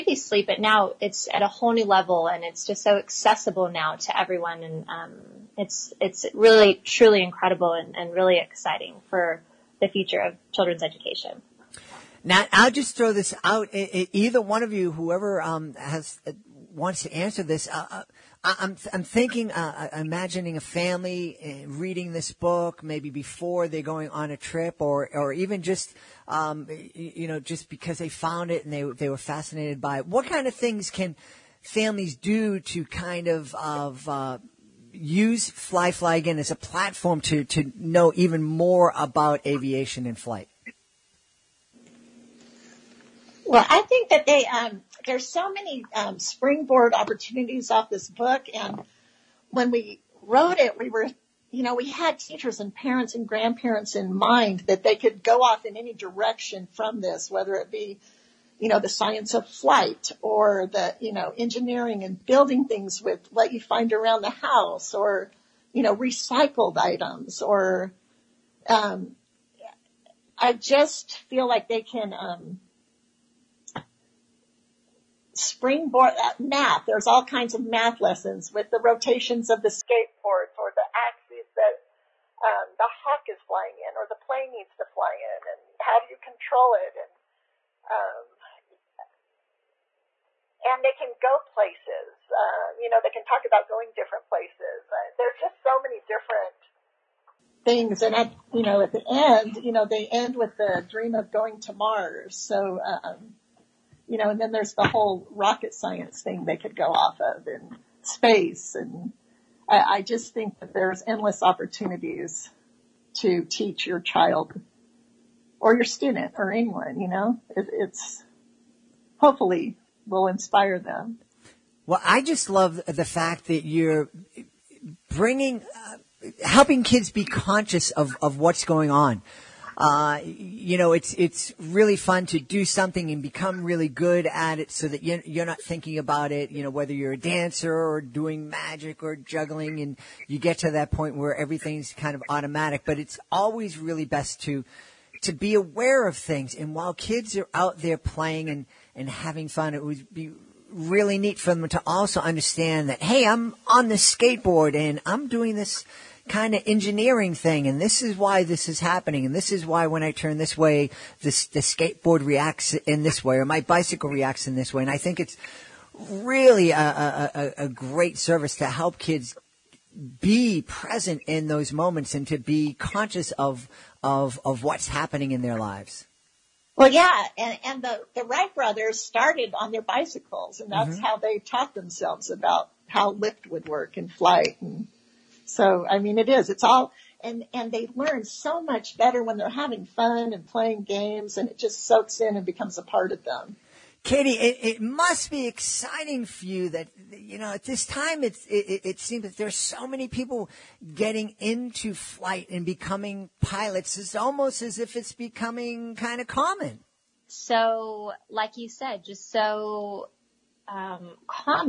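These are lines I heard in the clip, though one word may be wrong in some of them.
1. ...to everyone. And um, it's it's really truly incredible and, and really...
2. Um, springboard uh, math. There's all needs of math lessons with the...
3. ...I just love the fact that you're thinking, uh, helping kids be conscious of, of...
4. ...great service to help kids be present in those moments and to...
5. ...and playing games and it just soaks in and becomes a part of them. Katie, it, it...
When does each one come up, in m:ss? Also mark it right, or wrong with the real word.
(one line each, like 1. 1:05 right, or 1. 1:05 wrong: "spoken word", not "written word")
1. 0:03 right
2. 1:12 wrong: "kinds", not "needs"
3. 2:02 wrong: "bringing", not "thinking"
4. 2:47 right
5. 3:10 right.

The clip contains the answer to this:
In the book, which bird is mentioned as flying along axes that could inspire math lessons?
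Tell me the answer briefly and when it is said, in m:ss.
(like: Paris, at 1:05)
hawk, at 1:22.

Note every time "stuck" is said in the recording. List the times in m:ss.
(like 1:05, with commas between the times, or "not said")
not said.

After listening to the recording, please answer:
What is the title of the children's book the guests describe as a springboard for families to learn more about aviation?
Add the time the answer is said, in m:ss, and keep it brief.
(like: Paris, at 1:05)
Fly Fly, at 0:35.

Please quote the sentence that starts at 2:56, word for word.
Well, yeah, and, and the, the Wright brothers started on their bicycles, and that's mm-hmm.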